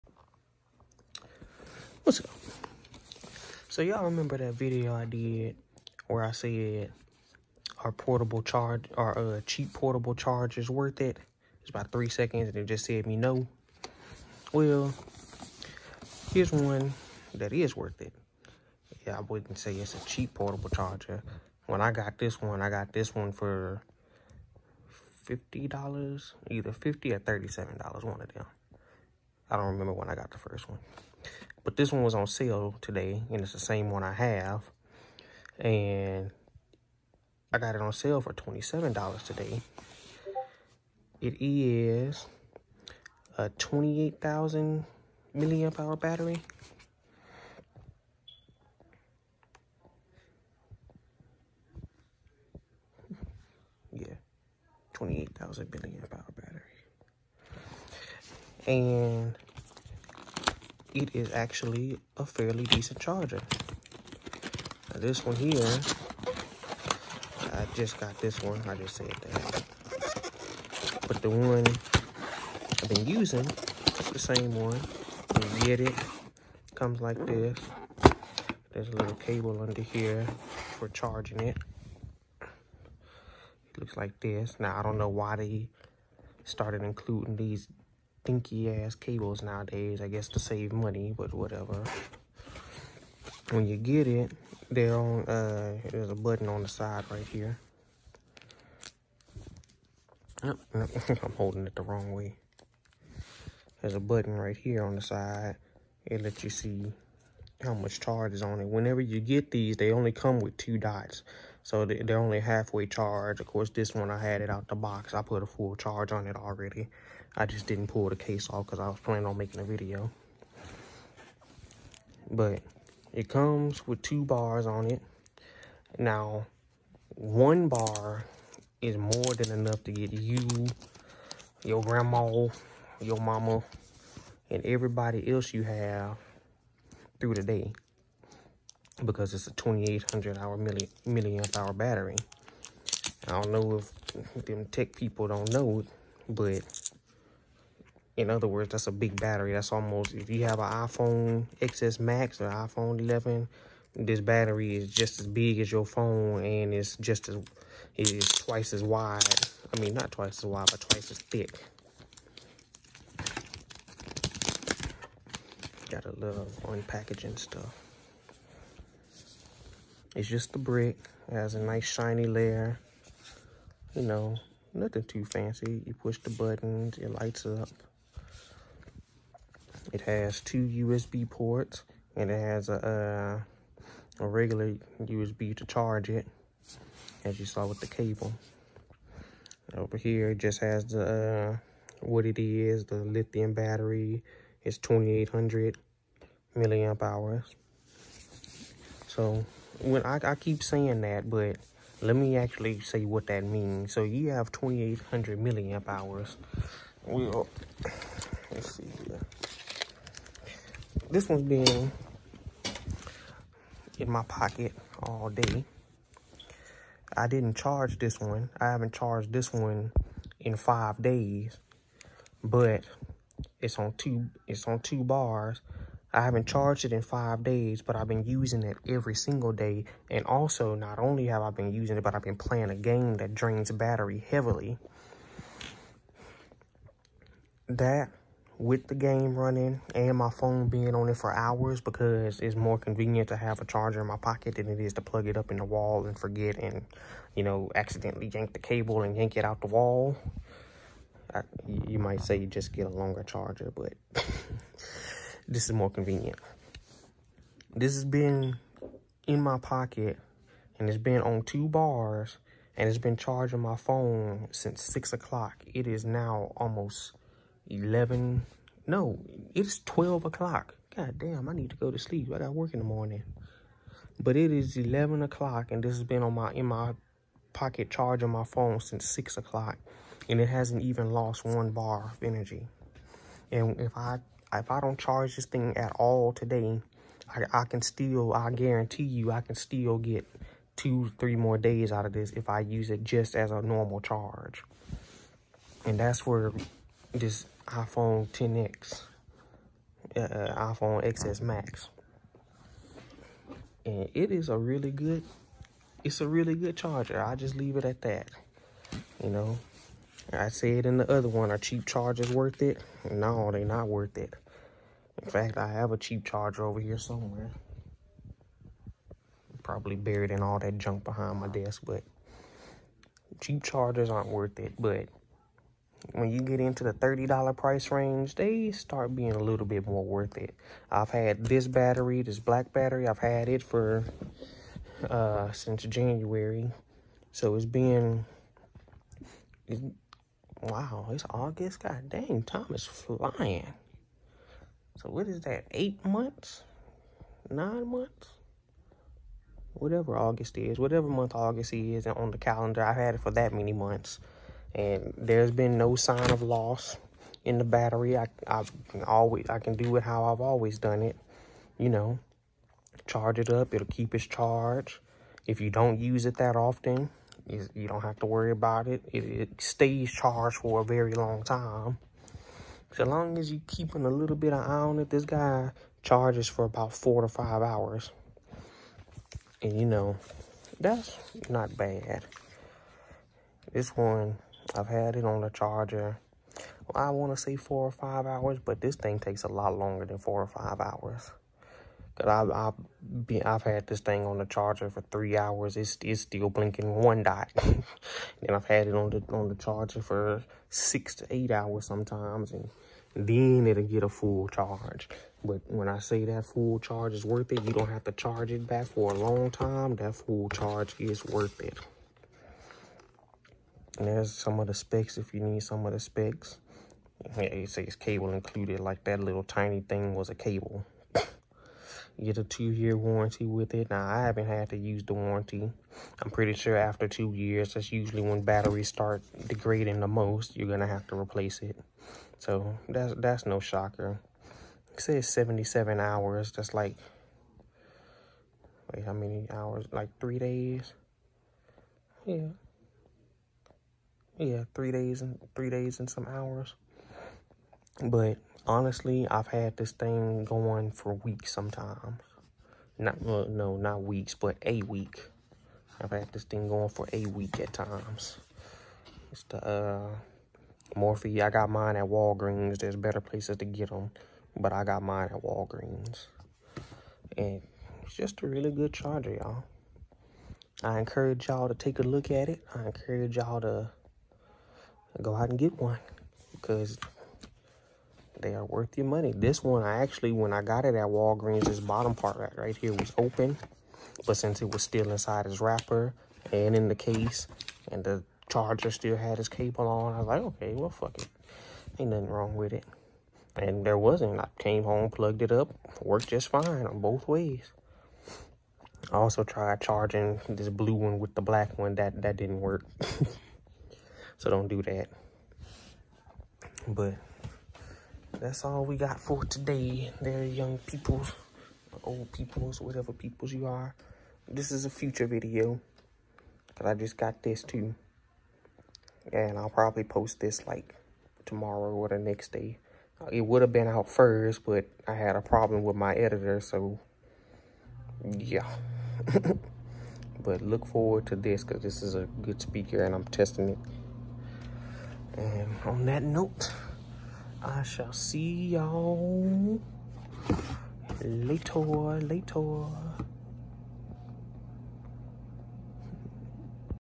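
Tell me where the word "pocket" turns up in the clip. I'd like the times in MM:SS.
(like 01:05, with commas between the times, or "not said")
03:34, 04:04, 04:19, 04:37.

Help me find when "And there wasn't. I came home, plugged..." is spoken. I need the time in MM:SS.
08:13.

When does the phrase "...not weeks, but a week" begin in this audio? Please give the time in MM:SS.
07:33.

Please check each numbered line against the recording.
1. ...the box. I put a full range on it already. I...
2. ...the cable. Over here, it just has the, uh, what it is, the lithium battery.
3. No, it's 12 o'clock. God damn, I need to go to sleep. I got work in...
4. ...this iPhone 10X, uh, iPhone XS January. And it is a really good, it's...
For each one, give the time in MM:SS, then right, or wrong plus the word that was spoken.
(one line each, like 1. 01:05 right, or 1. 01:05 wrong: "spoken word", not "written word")
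1. 01:54 wrong: "charge", not "range"
2. 03:07 right
3. 04:28 right
4. 04:57 wrong: "Max", not "January".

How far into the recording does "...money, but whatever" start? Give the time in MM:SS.
01:30.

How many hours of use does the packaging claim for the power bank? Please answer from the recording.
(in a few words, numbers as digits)
77.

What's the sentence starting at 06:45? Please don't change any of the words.
But when I say that full charge is worth it, you don't have to charge it back for a long time.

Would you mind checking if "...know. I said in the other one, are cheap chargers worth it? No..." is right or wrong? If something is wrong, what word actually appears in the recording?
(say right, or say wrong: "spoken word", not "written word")
right.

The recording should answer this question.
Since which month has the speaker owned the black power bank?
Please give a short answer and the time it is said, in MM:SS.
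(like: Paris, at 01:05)
January, at 05:35.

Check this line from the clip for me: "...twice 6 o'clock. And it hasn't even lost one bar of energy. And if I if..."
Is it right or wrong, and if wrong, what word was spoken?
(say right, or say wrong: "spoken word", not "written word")
wrong: "since", not "twice".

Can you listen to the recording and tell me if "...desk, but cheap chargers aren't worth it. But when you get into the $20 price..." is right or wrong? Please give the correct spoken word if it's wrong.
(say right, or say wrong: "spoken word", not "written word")
wrong: "30", not "20".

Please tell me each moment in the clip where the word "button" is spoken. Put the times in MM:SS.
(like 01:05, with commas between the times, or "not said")
01:36, 01:43, 02:56.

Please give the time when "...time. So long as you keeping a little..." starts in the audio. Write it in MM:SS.
06:11.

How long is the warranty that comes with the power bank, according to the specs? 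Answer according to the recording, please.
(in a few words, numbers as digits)
2 years.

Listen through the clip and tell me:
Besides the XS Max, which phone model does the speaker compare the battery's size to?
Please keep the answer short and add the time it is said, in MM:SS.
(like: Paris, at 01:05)
iPhone 11, at 02:32.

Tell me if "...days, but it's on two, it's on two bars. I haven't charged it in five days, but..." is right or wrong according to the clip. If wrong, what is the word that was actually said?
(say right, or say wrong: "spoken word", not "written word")
right.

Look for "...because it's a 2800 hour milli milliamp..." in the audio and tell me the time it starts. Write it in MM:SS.
02:19.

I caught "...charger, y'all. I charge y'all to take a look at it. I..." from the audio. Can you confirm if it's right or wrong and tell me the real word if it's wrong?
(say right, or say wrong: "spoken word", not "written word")
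wrong: "encourage", not "charge".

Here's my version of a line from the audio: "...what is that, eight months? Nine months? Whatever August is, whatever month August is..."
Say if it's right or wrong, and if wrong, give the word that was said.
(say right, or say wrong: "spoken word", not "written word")
right.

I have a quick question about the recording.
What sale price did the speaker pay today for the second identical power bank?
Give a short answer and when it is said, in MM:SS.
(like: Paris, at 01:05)
$27, at 00:38.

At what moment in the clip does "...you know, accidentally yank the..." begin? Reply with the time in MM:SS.
04:07.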